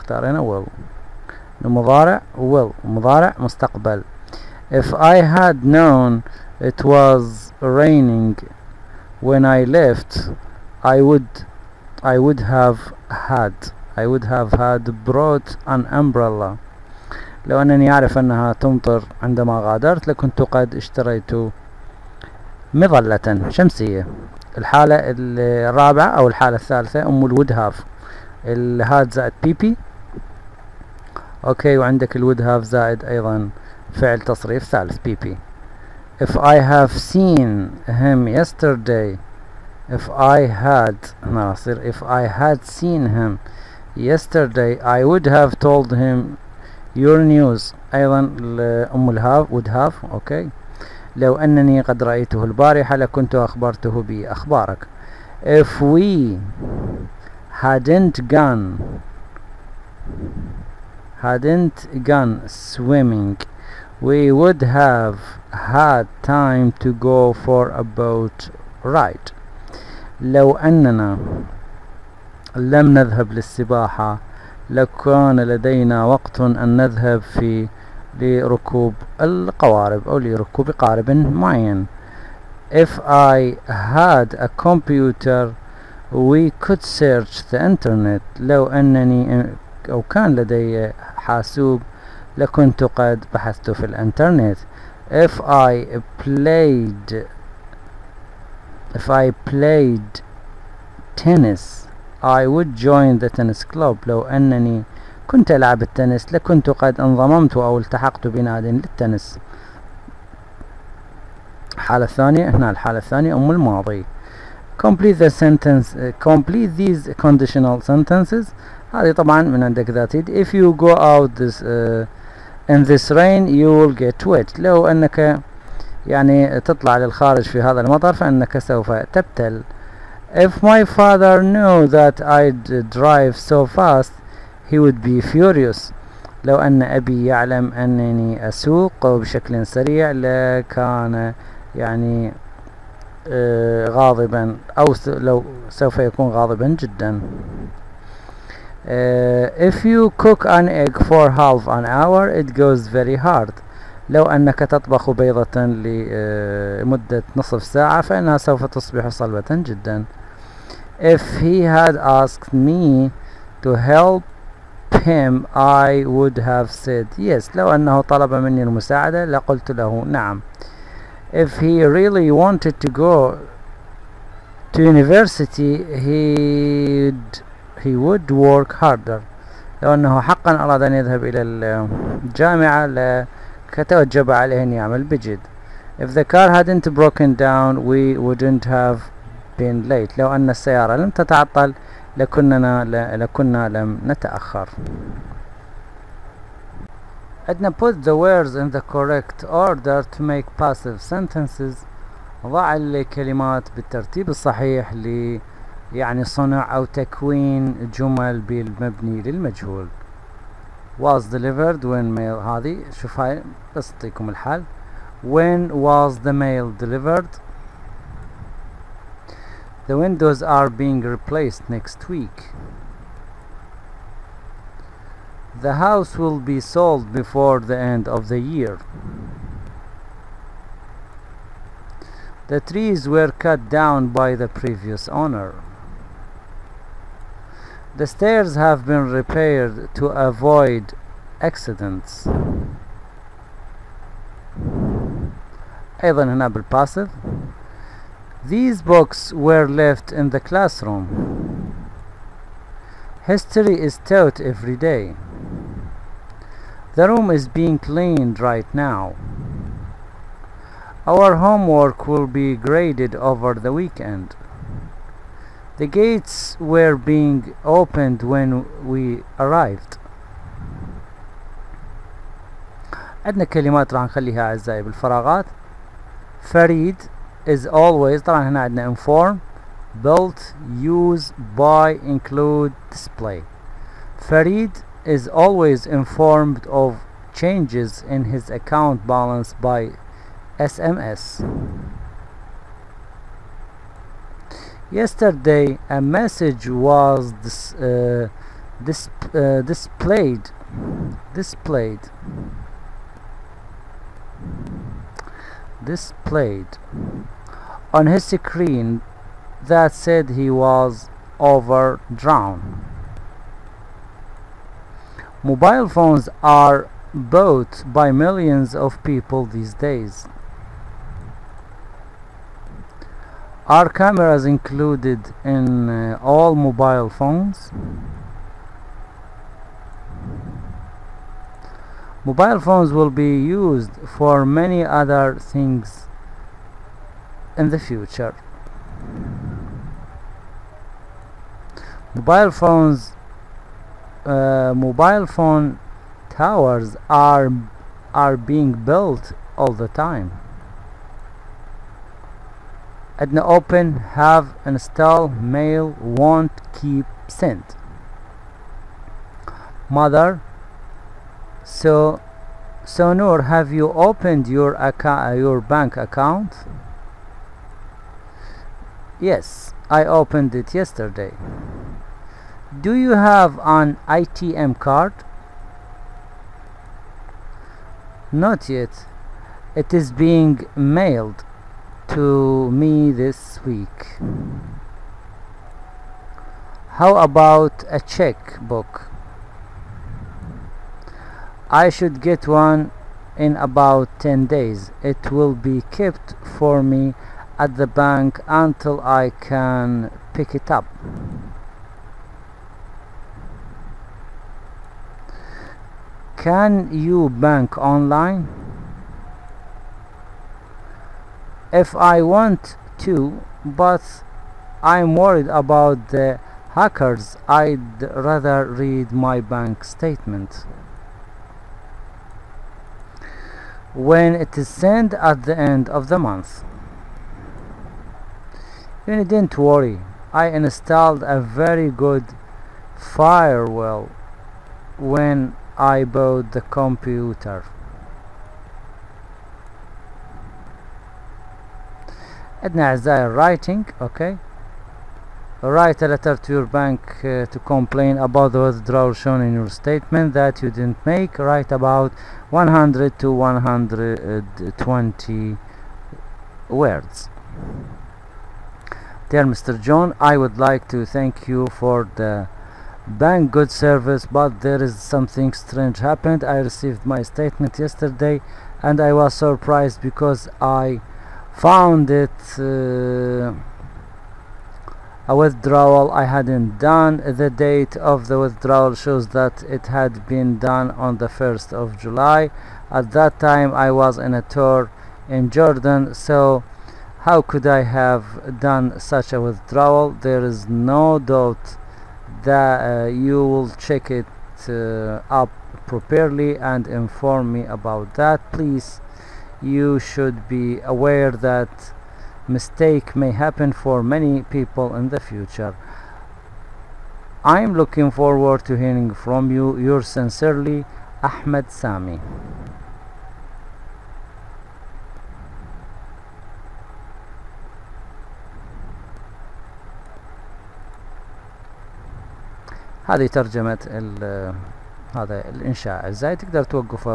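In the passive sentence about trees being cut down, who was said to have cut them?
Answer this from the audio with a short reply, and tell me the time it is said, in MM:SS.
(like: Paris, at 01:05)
the previous owner, at 03:54.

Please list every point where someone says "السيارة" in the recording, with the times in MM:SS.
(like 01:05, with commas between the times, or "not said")
03:10.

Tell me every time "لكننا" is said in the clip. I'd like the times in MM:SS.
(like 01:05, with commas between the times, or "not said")
03:12.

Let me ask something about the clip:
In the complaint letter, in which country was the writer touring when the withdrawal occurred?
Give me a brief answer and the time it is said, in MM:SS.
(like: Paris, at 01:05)
Jordan, at 08:05.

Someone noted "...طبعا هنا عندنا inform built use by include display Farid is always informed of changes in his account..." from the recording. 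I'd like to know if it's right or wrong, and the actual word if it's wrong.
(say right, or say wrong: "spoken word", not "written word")
right.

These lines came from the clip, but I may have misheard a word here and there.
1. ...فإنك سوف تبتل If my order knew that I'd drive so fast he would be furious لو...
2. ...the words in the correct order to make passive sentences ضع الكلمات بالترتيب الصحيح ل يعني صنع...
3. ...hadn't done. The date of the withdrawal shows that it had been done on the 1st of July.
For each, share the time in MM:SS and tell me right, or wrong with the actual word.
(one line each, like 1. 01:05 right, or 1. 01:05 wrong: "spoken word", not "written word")
1. 02:08 wrong: "father", not "order"
2. 03:18 right
3. 07:56 right.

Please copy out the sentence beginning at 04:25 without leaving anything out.
The gates were being opened when we arrived.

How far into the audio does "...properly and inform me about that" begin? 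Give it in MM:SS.
08:15.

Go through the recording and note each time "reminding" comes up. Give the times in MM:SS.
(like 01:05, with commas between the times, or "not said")
not said.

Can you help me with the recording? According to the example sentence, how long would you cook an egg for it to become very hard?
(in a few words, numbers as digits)
half an hour.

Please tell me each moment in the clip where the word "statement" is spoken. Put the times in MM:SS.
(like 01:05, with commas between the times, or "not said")
06:59, 07:29, 07:47.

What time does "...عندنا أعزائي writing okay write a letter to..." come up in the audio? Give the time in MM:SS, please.
07:22.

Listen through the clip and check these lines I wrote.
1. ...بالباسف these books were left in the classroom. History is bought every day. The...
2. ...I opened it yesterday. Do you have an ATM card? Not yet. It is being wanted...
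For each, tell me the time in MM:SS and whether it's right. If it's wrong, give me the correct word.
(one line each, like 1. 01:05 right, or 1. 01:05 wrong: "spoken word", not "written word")
1. 04:06 wrong: "taught", not "bought"
2. 06:09 wrong: "mailed", not "wanted".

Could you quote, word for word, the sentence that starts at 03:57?
The stairs have been repaired to avoid accidents.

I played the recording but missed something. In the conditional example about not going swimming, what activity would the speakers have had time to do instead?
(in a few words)
a boat ride.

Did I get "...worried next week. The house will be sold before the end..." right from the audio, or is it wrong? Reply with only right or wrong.
wrong.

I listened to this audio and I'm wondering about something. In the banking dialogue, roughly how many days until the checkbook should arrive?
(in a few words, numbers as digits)
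10 days.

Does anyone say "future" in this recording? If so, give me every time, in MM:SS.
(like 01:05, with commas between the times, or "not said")
05:37, 08:25.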